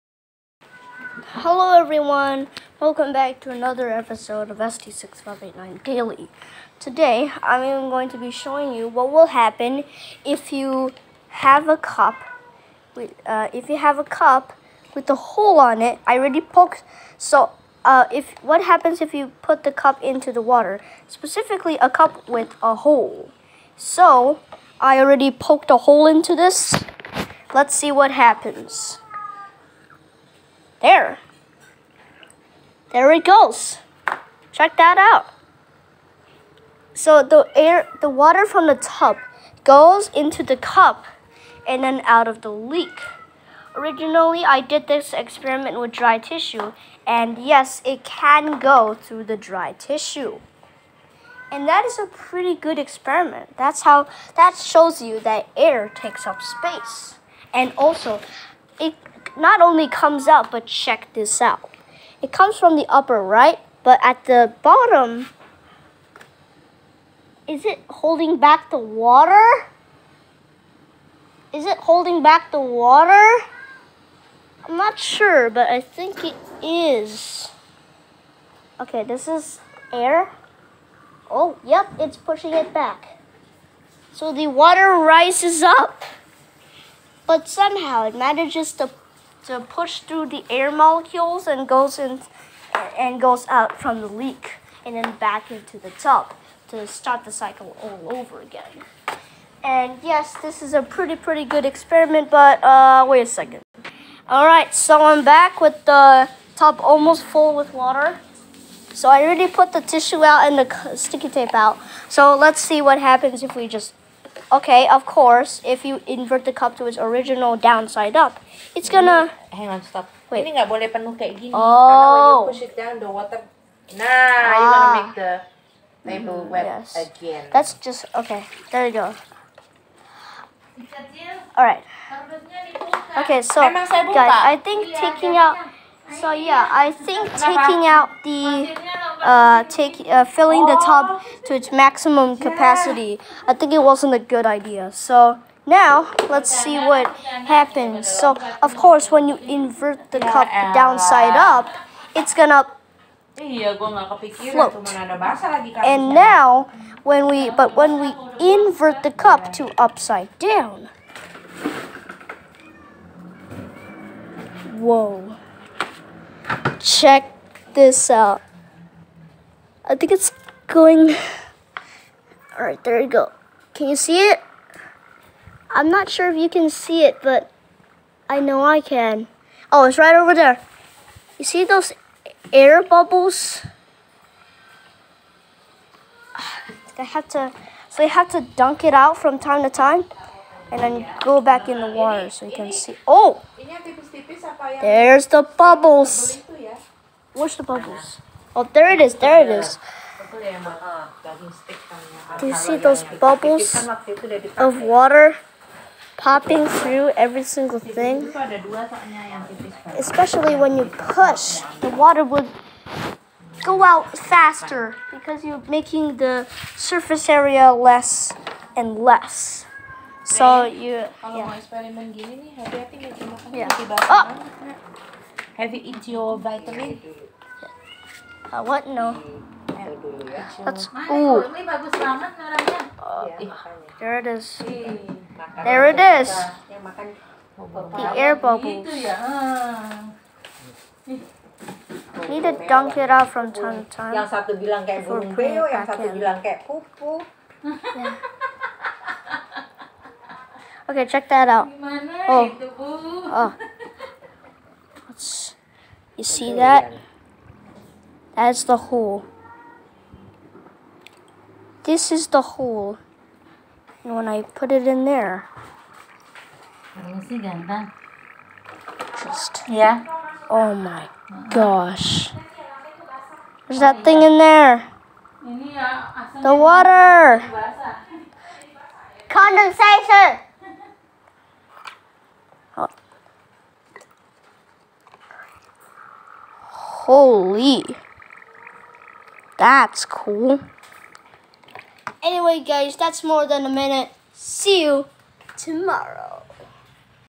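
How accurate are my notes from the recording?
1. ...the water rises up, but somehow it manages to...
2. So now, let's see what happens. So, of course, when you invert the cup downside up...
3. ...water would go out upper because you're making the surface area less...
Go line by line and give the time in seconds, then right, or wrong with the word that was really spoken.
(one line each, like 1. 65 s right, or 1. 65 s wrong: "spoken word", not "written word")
1. 84 s right
2. 144 s right
3. 211 s wrong: "faster", not "upper".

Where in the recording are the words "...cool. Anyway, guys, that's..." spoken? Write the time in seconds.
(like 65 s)
290 s.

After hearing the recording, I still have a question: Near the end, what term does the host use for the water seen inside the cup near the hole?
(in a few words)
Condensation.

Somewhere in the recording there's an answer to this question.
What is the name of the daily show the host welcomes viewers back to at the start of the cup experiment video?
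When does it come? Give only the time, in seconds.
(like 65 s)
4 s.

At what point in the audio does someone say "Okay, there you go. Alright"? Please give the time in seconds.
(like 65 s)
128 s.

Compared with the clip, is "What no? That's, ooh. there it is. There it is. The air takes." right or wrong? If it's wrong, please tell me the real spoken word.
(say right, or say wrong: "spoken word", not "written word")
wrong: "bubbles", not "takes".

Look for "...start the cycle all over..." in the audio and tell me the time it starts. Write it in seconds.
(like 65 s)
96 s.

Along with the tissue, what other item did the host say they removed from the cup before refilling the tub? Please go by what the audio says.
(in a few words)
sticky tape.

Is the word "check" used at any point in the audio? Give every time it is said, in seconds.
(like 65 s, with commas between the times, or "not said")
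34 s, 60 s, 166 s, 251 s.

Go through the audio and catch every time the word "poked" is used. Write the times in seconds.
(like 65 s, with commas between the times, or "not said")
16 s, 25 s.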